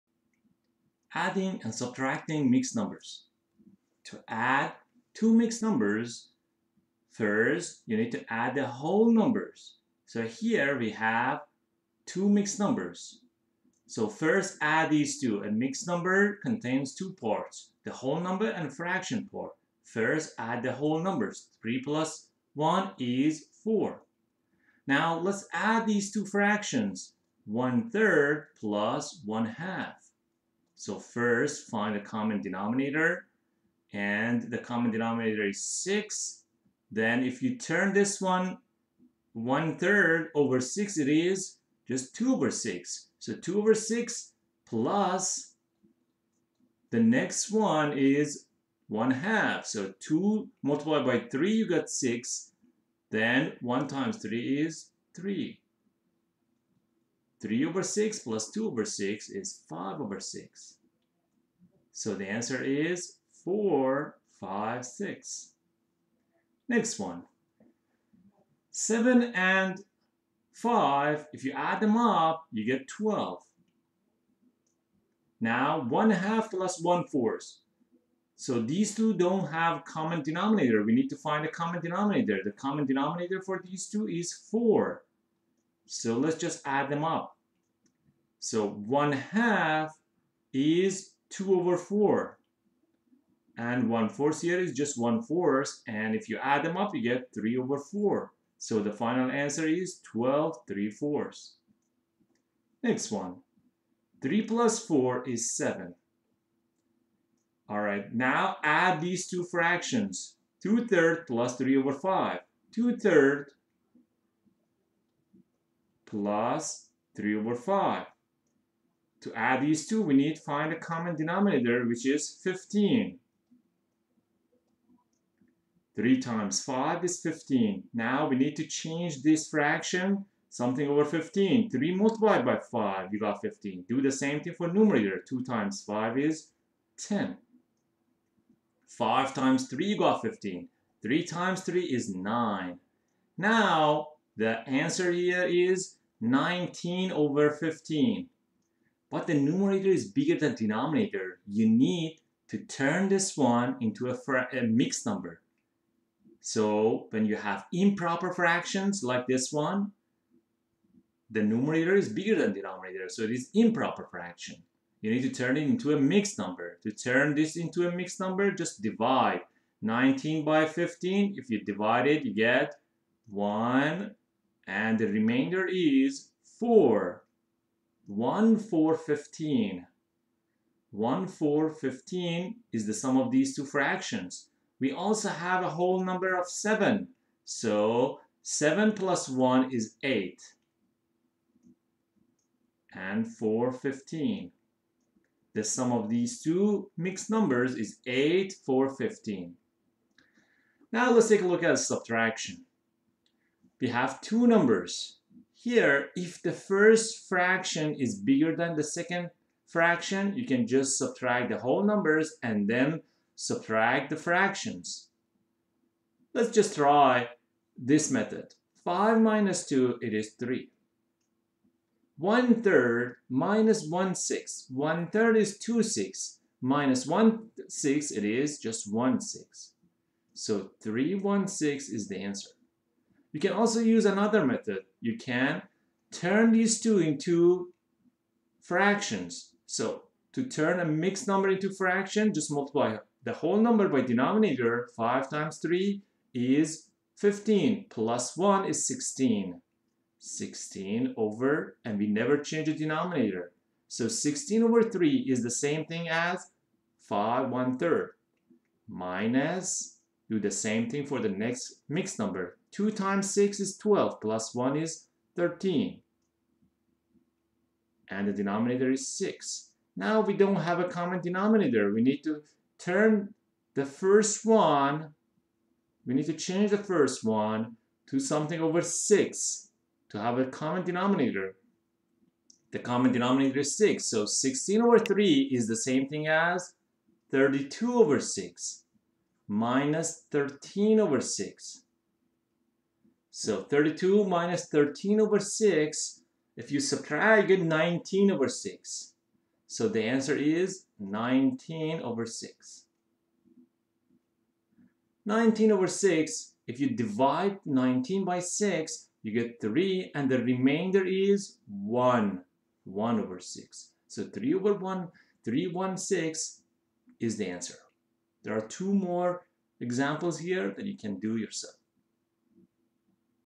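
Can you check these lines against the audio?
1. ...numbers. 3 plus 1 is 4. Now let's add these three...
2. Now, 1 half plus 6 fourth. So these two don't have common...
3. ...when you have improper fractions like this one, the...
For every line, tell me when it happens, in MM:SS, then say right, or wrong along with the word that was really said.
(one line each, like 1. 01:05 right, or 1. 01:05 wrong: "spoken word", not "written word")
1. 00:20 wrong: "two", not "three"
2. 01:15 wrong: "1", not "6"
3. 02:37 right.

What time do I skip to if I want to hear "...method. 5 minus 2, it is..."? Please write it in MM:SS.
03:38.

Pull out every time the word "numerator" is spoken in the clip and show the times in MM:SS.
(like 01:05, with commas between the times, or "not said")
02:14, 02:29, 02:41.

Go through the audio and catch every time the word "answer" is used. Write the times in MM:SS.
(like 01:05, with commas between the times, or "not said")
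01:02, 01:39, 02:24, 03:52, 05:00, 05:17.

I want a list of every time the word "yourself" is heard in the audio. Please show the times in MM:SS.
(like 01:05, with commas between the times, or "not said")
05:21.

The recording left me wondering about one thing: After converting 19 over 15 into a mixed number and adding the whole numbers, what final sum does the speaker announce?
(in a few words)
8 4/15.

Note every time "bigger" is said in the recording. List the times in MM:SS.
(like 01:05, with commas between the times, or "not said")
02:30, 02:42, 03:28.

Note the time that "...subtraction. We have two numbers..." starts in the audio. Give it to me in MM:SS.
03:21.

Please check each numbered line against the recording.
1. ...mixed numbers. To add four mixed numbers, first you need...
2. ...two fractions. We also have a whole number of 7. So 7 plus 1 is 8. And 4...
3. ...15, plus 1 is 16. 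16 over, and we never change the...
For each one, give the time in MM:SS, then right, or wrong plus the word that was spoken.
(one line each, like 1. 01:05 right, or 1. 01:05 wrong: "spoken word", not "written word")
1. 00:02 wrong: "two", not "four"
2. 03:03 right
3. 04:07 right.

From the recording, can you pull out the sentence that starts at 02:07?
Now we need to change this fraction, something over 15.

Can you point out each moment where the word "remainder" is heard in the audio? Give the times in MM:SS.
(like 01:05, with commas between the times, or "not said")
02:55, 05:10.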